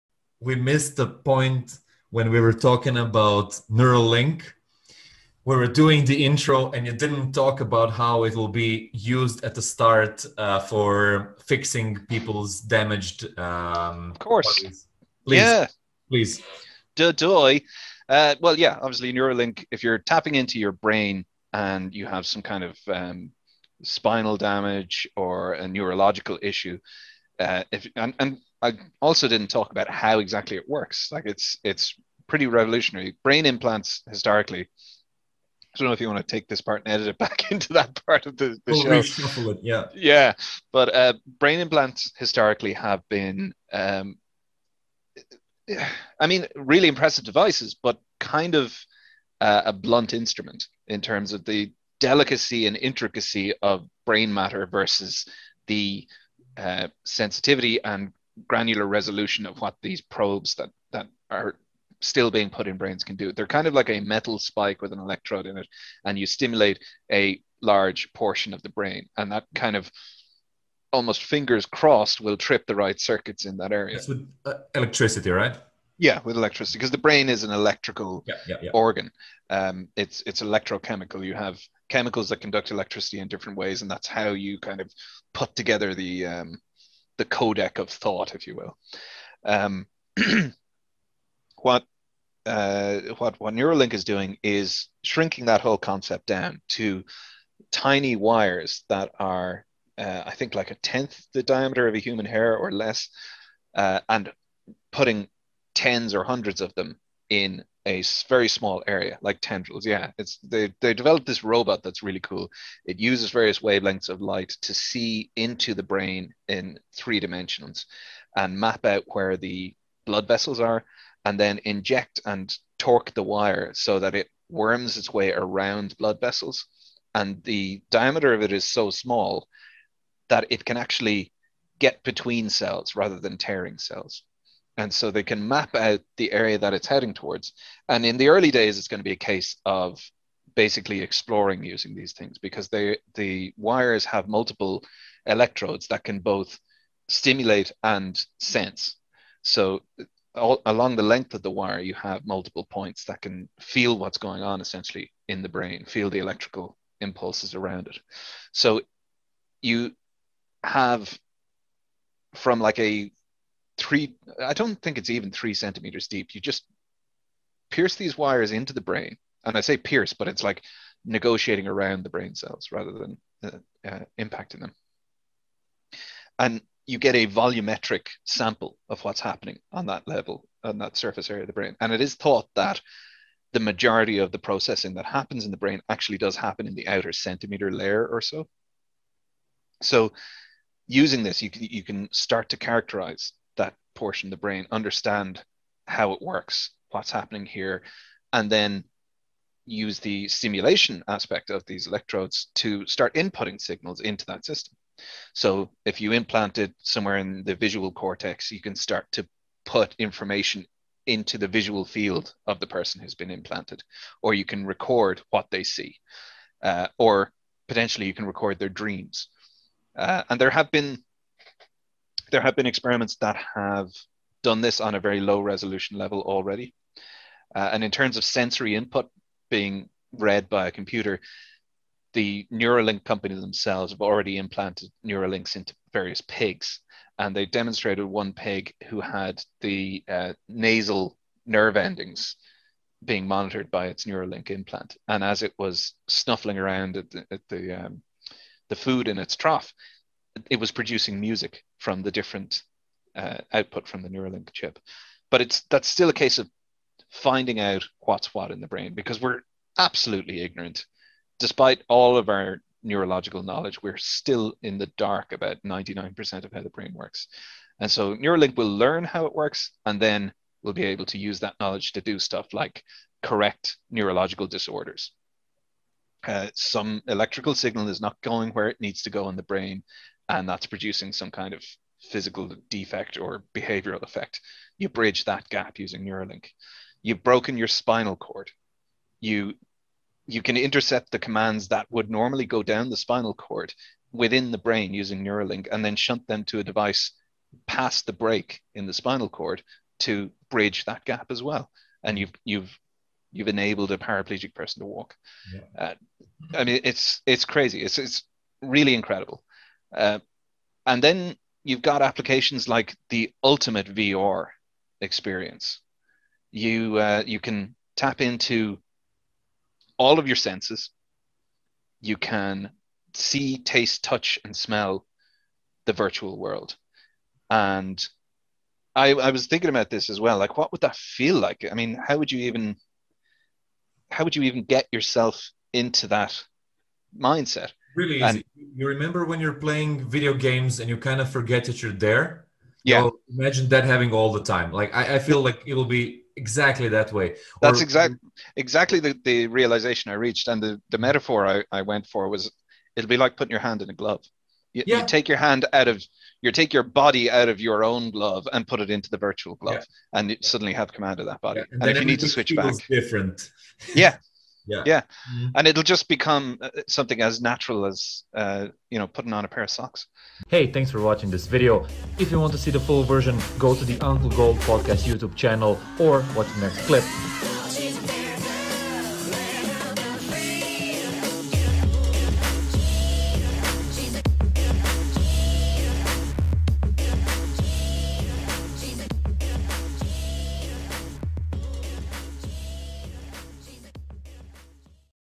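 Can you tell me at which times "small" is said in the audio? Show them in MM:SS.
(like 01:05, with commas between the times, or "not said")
01:48, 02:08.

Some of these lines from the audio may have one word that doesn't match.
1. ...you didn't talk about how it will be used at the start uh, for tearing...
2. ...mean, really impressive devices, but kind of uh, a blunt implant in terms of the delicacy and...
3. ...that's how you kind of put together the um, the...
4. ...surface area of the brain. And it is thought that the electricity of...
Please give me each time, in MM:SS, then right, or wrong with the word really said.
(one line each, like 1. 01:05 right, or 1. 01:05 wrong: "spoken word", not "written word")
1. 00:06 wrong: "fixing", not "tearing"
2. 00:46 wrong: "instrument", not "implant"
3. 01:23 right
4. 03:00 wrong: "majority", not "electricity".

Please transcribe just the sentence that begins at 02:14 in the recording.
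And so they can map out the area that it's heading towards.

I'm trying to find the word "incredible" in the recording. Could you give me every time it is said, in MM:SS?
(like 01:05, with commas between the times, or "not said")
05:08.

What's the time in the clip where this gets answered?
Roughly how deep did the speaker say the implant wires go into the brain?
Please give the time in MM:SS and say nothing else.
02:45.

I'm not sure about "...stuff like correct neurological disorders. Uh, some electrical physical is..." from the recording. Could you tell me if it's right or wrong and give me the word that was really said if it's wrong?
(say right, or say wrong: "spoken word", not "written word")
wrong: "signal", not "physical".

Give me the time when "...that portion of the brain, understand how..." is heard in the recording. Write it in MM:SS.
03:13.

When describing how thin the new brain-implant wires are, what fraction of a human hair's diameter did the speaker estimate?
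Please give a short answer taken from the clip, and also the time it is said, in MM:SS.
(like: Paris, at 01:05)
a tenth, at 01:40.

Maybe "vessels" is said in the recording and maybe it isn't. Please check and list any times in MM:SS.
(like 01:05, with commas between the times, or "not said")
02:00, 02:06.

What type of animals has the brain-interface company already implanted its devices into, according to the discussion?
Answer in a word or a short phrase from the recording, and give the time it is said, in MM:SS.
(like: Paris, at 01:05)
pigs, at 03:56.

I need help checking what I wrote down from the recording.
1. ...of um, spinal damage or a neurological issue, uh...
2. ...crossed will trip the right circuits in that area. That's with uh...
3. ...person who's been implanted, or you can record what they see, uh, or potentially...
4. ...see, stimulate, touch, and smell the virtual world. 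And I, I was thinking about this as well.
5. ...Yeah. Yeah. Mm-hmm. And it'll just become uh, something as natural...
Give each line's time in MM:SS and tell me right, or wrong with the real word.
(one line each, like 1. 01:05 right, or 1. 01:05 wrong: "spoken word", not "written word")
1. 00:22 right
2. 01:11 right
3. 03:32 right
4. 05:23 wrong: "taste", not "stimulate"
5. 06:04 right.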